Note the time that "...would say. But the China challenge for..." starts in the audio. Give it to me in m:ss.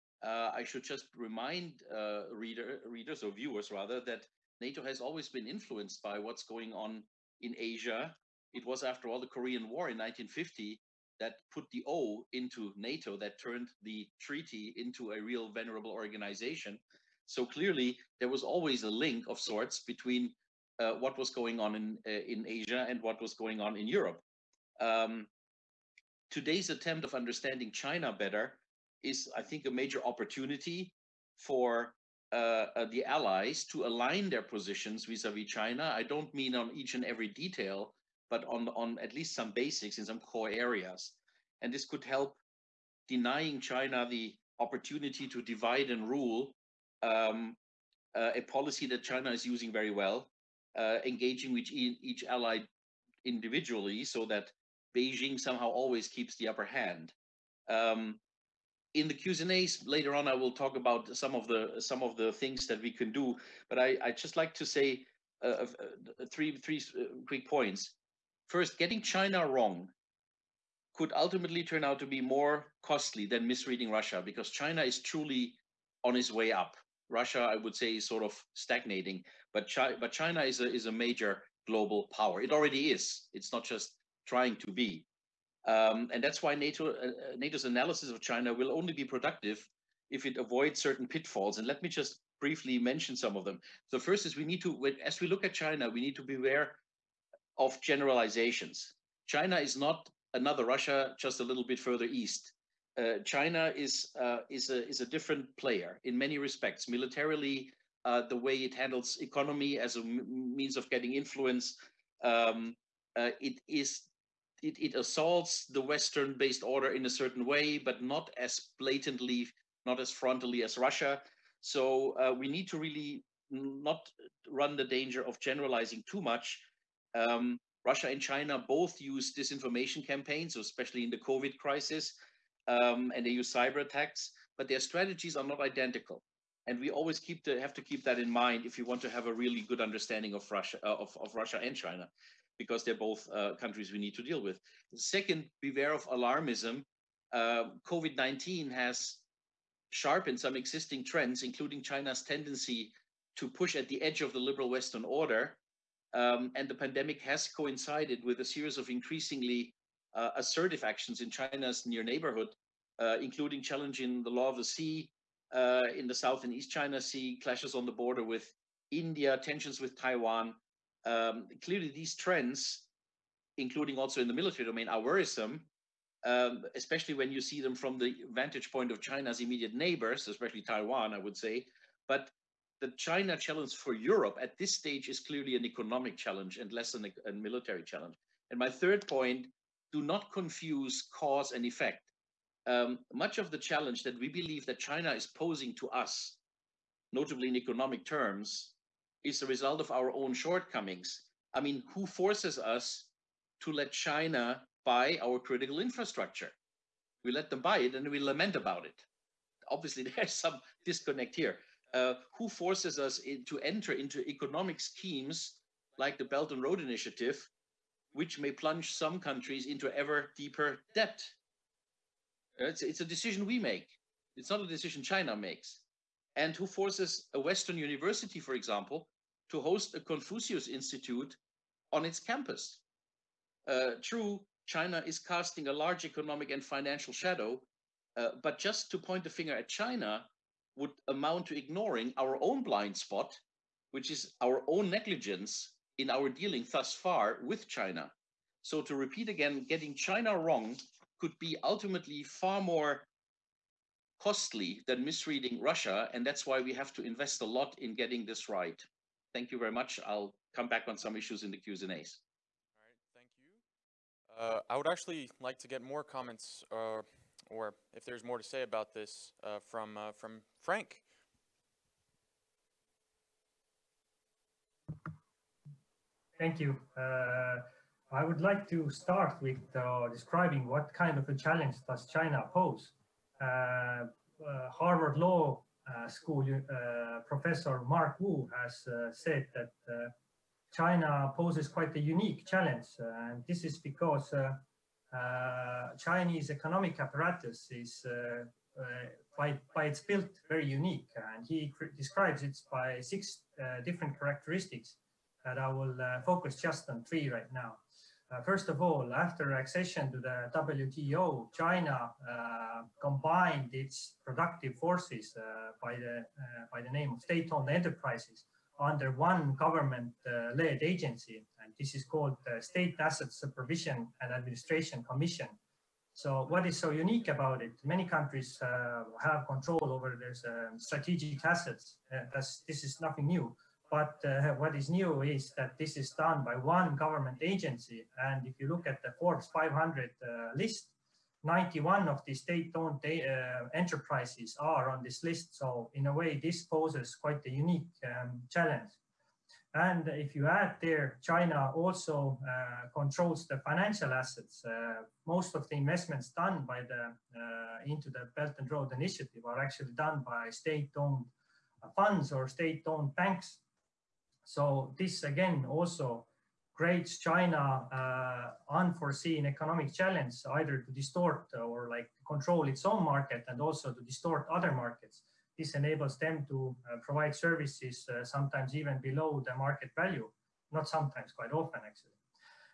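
3:01.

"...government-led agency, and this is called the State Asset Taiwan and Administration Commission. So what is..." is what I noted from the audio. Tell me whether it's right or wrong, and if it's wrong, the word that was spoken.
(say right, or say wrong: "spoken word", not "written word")
wrong: "Supervision", not "Taiwan".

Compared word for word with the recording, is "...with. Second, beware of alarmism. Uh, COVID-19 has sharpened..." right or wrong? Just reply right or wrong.
right.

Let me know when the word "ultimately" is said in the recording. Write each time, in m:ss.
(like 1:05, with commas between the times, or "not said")
1:11, 4:11.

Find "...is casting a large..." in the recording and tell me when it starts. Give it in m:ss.
3:55.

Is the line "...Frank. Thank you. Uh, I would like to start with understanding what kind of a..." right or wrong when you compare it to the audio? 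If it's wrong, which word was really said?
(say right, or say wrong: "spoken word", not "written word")
wrong: "describing", not "understanding".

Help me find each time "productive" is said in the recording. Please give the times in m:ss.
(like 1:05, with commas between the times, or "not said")
1:29, 5:14.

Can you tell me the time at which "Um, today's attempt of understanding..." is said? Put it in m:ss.
0:24.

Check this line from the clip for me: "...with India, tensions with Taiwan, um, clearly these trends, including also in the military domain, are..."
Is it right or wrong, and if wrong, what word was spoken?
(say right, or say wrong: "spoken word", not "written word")
right.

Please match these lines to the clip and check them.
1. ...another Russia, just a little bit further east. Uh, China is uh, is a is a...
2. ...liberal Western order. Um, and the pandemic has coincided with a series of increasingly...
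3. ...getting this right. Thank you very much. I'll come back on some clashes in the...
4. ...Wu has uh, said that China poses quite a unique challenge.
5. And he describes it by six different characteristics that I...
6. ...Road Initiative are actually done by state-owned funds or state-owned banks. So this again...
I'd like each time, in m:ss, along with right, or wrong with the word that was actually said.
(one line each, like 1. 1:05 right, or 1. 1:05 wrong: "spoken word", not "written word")
1. 1:40 right
2. 2:34 right
3. 4:17 wrong: "issues", not "clashes"
4. 4:48 right
5. 5:01 right
6. 5:58 right.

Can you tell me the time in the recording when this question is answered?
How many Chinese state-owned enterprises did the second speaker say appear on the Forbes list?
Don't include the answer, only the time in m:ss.
5:41.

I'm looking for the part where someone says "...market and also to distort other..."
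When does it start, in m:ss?
6:13.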